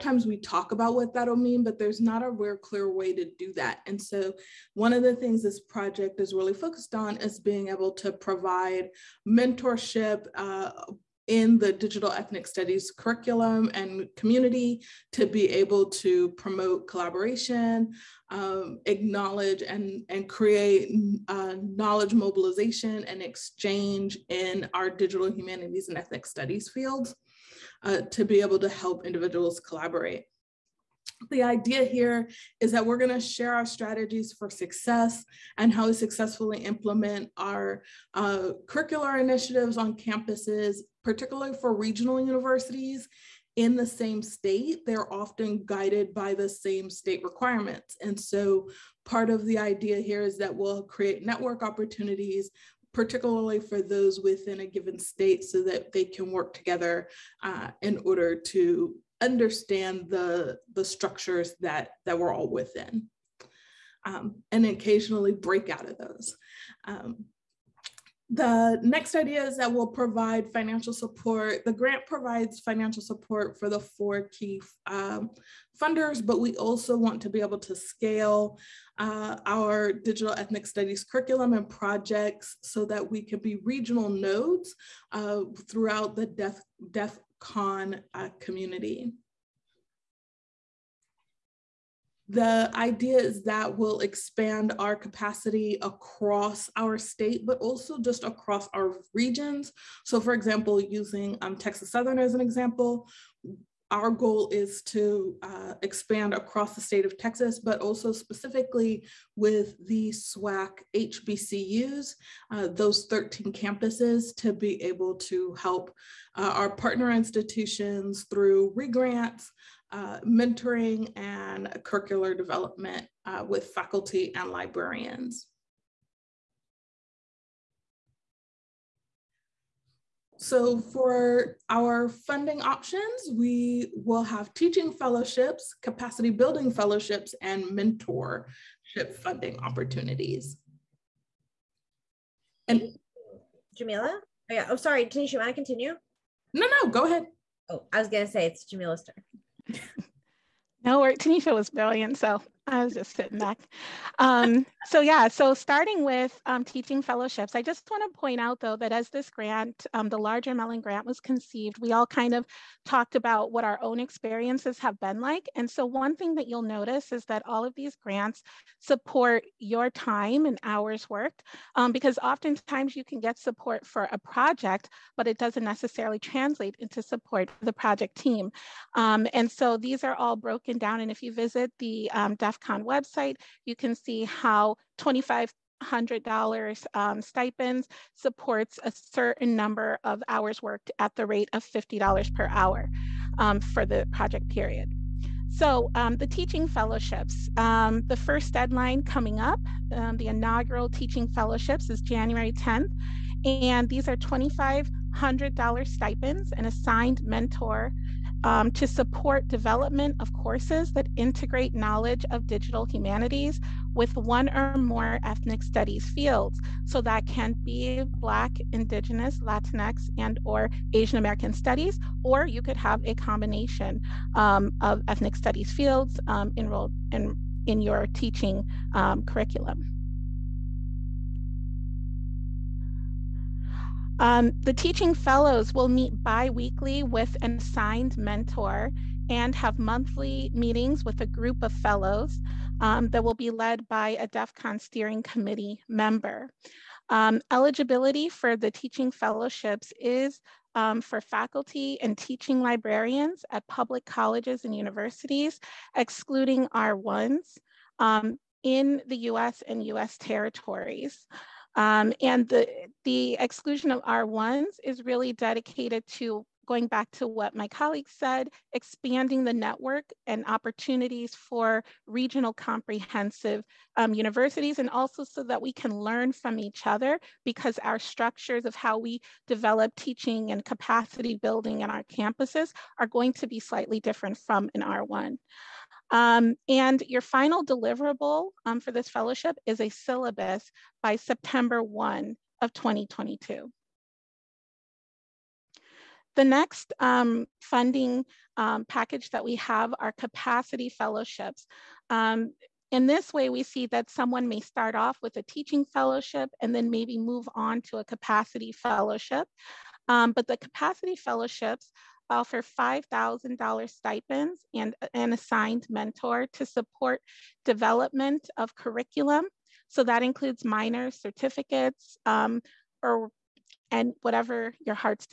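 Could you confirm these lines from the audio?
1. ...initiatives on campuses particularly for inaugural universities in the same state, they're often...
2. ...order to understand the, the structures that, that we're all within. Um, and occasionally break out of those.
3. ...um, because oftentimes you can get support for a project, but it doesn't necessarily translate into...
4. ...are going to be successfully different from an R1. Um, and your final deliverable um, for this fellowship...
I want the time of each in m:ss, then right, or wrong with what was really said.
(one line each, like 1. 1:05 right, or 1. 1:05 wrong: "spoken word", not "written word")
1. 0:39 wrong: "regional", not "inaugural"
2. 0:58 right
3. 2:51 right
4. 4:42 wrong: "slightly", not "successfully".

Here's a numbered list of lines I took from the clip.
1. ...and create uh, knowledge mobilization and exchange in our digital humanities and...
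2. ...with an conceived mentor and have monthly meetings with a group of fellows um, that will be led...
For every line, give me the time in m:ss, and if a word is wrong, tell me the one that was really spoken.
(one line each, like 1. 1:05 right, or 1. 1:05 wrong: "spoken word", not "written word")
1. 0:20 right
2. 3:57 wrong: "assigned", not "conceived".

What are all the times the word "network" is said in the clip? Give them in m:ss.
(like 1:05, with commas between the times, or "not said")
0:51, 4:29.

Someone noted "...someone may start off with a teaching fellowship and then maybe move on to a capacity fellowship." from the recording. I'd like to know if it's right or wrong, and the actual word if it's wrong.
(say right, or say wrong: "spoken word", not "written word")
right.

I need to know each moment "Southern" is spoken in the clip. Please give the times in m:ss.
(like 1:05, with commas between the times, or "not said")
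1:41.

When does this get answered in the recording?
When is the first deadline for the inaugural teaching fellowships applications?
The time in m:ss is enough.
3:22.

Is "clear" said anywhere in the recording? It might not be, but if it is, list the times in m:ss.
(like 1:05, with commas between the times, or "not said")
0:02.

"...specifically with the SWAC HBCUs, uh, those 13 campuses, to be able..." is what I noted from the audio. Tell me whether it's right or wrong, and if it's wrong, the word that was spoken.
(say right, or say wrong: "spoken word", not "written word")
right.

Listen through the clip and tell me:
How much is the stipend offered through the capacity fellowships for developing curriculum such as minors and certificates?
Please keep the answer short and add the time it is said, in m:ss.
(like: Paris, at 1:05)
$5,000, at 5:12.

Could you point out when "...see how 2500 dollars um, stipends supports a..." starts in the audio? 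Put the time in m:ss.
3:03.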